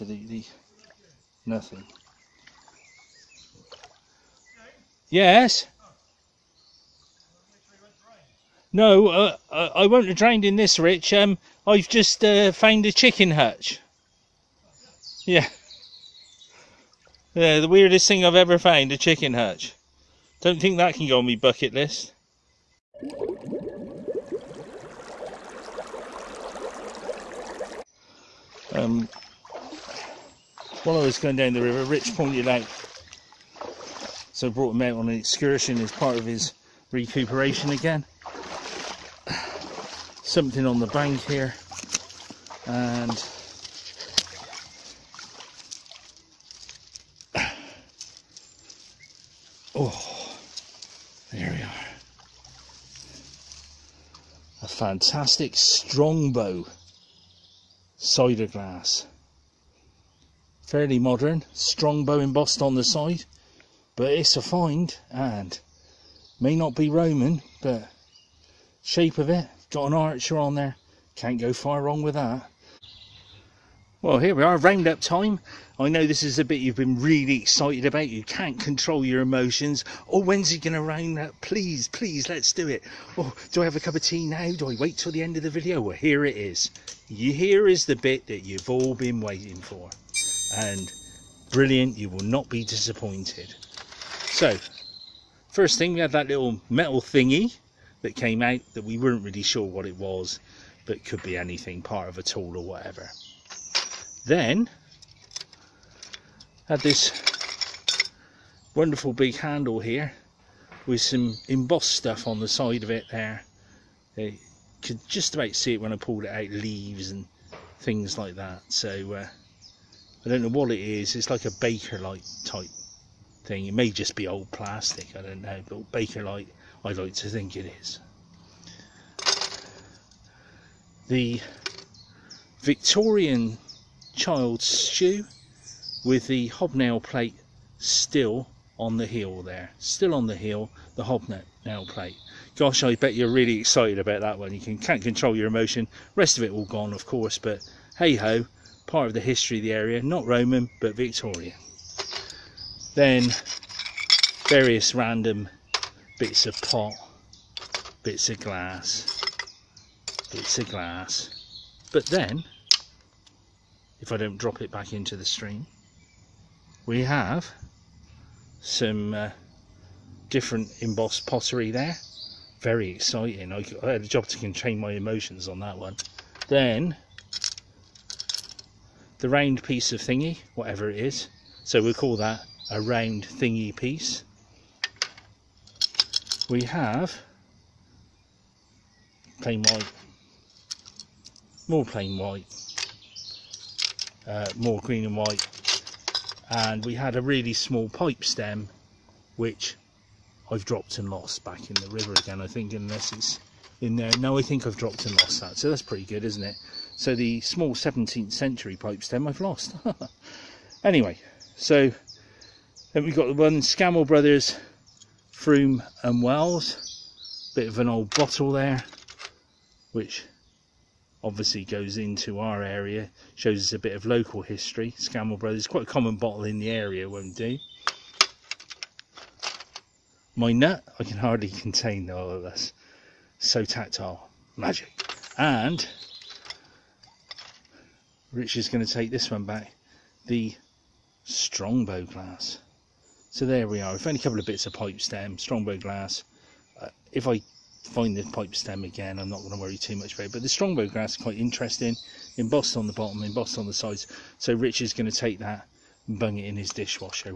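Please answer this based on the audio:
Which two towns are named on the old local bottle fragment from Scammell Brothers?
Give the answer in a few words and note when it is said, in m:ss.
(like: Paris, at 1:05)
Frome and Wells, at 3:35.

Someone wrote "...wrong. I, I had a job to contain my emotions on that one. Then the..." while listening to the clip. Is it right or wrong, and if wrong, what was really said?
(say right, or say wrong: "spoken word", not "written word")
wrong: "exciting", not "wrong".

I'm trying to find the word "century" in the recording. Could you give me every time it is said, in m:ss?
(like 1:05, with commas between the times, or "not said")
3:28.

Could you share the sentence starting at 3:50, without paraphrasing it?
My nut, I can hardly contain all of this.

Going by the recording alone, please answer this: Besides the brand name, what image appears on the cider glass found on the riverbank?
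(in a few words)
An archer.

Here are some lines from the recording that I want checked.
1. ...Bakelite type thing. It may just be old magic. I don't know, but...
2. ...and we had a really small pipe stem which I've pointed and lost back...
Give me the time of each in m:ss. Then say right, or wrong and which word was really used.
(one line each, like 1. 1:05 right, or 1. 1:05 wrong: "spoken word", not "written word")
1. 2:01 wrong: "plastic", not "magic"
2. 3:16 wrong: "dropped", not "pointed".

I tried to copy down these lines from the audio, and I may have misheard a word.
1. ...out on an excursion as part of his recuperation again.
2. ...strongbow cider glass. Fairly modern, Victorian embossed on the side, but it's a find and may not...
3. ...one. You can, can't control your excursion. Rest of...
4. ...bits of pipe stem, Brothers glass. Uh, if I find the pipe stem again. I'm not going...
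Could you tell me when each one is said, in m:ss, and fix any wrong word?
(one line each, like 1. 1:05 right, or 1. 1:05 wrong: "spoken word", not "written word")
1. 0:34 right
2. 0:55 wrong: "Strongbow", not "Victorian"
3. 2:24 wrong: "emotion", not "excursion"
4. 4:04 wrong: "Strongbow", not "Brothers".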